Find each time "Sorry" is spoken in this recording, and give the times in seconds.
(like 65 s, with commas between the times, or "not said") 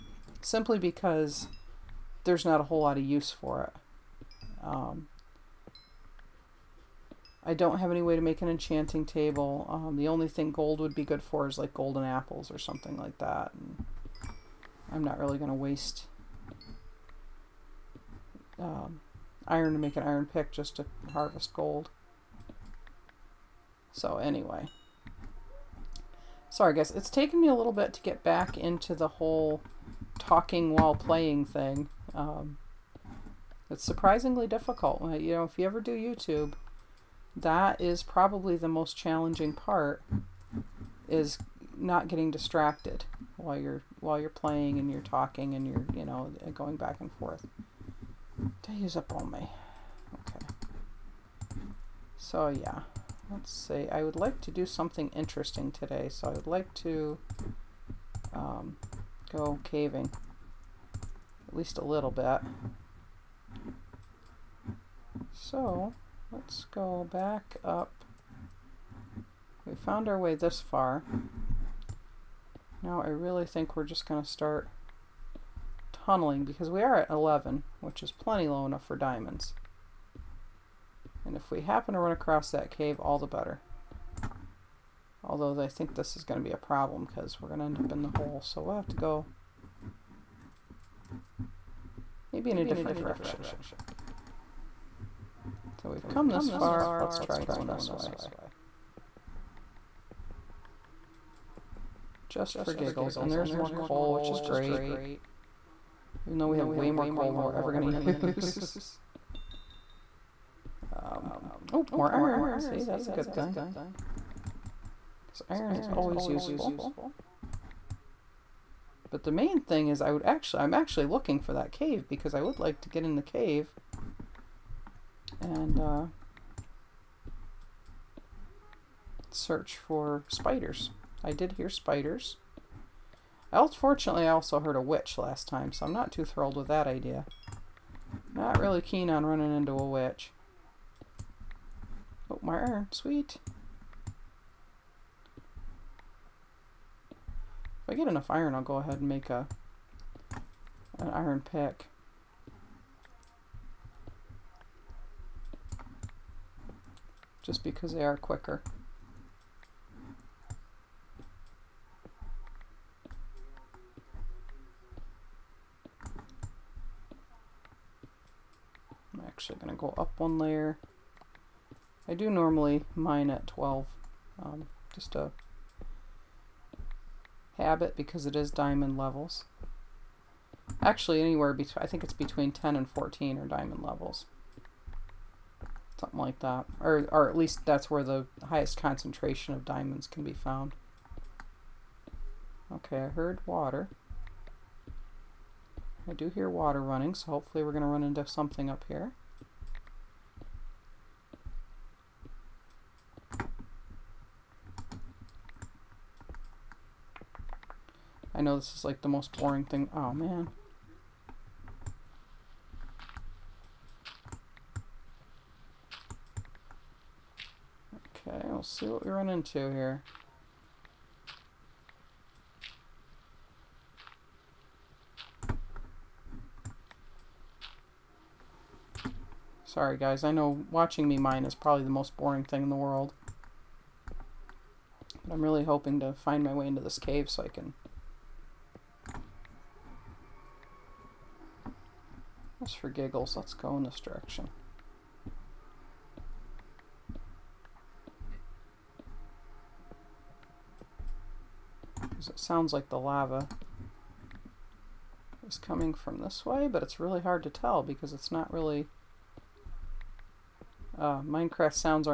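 26 s, 229 s.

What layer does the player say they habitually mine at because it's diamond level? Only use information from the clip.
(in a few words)
12.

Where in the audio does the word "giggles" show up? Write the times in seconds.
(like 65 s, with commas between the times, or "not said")
102 s, 242 s.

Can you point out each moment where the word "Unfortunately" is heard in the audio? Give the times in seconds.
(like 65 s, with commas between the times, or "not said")
133 s.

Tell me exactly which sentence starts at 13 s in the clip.
And I'm not really going to waste um, iron to make an iron pick just to harvest gold.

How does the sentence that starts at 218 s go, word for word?
we'll see what we run into here.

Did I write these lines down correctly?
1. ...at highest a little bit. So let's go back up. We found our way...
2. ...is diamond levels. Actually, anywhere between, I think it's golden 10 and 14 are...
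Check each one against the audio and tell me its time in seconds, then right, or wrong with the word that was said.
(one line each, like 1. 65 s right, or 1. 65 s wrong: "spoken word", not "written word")
1. 61 s wrong: "least", not "highest"
2. 178 s wrong: "between", not "golden".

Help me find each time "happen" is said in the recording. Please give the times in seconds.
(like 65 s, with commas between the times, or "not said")
81 s.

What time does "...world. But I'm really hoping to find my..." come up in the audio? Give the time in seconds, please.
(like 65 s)
232 s.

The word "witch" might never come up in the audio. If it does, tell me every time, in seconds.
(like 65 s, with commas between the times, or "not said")
134 s, 139 s.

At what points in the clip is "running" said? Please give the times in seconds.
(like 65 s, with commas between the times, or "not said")
139 s, 196 s.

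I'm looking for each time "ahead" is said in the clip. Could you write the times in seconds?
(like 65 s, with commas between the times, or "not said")
148 s.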